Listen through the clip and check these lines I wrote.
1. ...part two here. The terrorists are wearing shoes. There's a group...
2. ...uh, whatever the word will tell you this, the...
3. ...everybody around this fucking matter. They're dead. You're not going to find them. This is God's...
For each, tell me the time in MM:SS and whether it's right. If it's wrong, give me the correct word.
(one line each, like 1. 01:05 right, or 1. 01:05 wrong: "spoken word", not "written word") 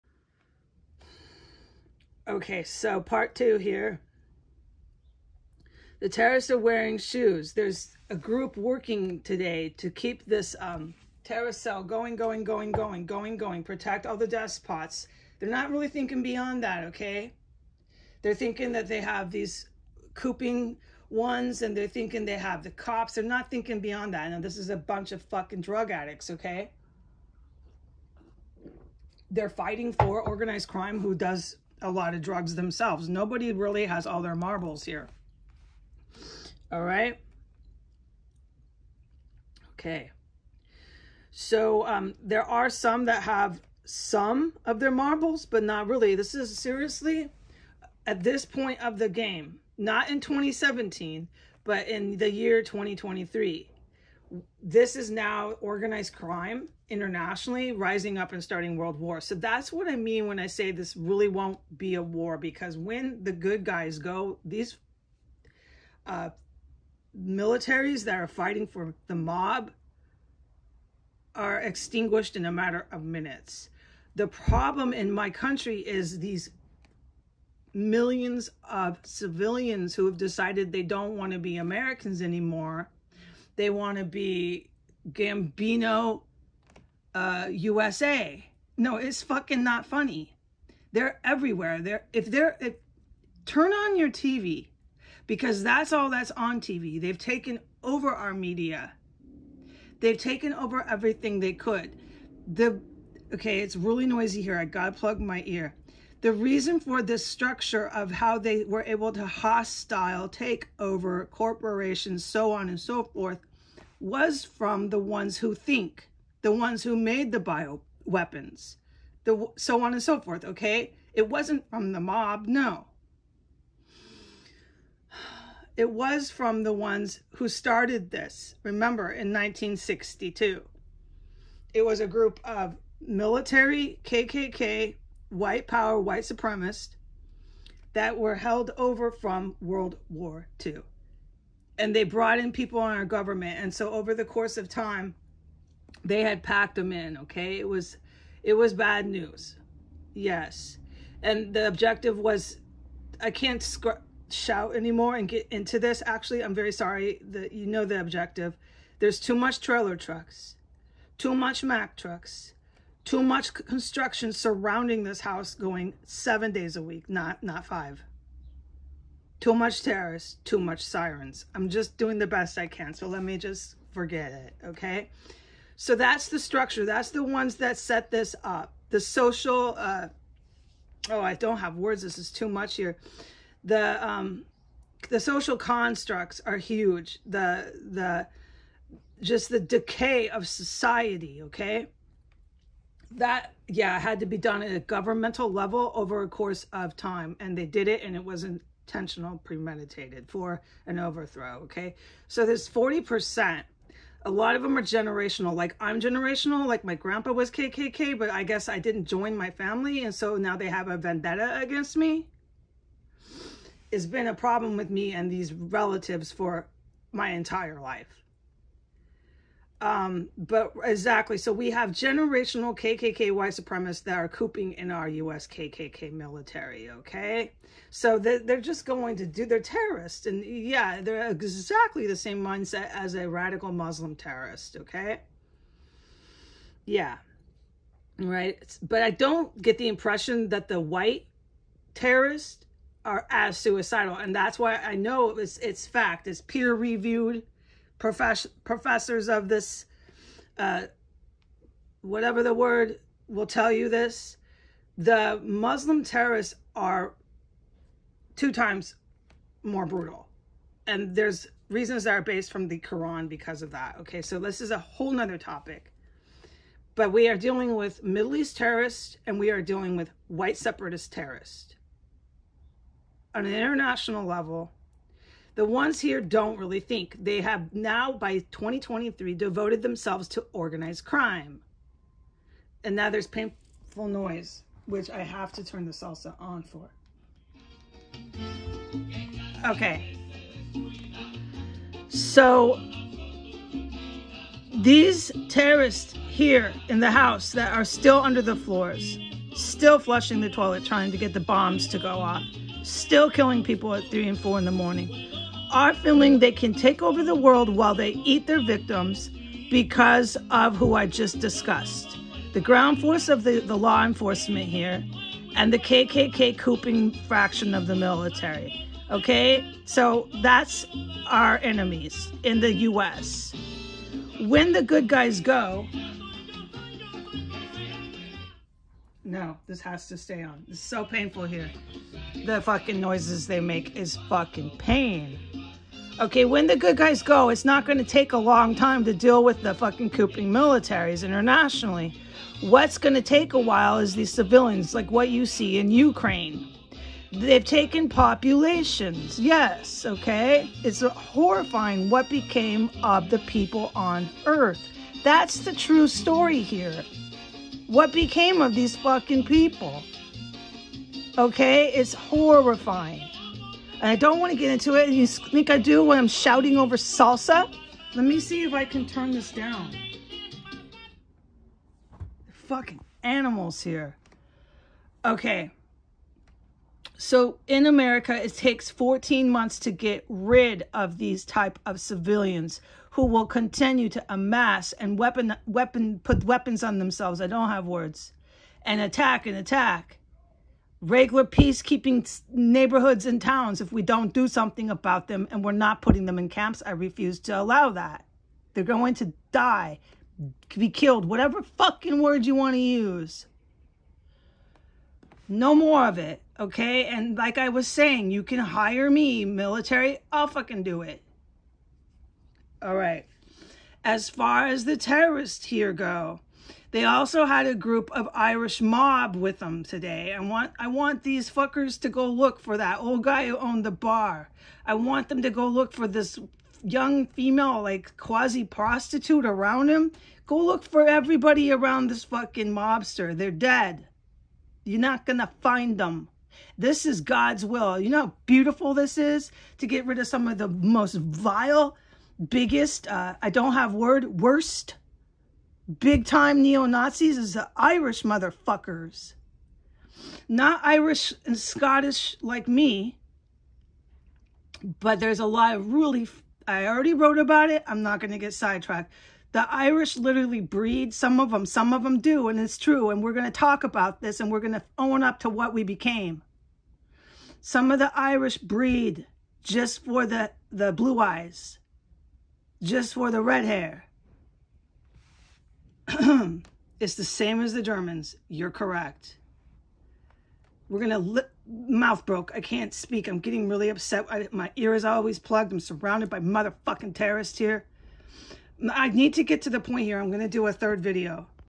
1. 00:03 right
2. 04:10 right
3. 07:11 wrong: "mobster", not "matter".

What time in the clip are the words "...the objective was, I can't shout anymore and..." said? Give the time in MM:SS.
02:31.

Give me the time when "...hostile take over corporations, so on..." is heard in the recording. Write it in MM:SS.
01:49.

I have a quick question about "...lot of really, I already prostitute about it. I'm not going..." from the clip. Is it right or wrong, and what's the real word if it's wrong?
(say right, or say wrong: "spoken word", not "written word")
wrong: "wrote", not "prostitute".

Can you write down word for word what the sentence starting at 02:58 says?
The social, uh, oh, I don't have words.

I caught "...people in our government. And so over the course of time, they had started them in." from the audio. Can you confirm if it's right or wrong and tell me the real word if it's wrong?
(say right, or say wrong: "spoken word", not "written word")
wrong: "packed", not "started".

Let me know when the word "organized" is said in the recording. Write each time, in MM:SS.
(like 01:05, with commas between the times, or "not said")
00:30, 00:55, 04:40.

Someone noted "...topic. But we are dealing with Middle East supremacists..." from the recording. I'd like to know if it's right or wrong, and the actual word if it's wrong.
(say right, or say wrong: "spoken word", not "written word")
wrong: "terrorists", not "supremacists".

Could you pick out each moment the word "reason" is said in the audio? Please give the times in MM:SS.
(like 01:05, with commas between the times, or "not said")
01:46, 04:21.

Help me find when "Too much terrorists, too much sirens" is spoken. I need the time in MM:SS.
02:49.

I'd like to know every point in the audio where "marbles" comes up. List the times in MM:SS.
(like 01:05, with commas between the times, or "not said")
00:34, 00:44.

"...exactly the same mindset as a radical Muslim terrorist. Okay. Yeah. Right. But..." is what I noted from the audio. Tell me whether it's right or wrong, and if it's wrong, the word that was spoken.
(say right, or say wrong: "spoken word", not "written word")
right.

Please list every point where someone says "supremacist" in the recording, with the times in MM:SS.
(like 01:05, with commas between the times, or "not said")
02:16, 03:43.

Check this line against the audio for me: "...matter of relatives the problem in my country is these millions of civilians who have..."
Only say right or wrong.
wrong.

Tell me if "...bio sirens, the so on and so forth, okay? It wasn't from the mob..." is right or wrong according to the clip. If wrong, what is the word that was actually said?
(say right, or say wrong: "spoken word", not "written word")
wrong: "weapons", not "sirens".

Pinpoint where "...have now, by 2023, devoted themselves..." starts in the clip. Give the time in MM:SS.
04:37.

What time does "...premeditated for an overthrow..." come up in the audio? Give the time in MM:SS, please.
03:19.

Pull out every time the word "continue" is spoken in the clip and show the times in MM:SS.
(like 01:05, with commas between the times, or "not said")
06:23.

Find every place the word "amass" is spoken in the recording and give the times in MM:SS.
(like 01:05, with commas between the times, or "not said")
06:24.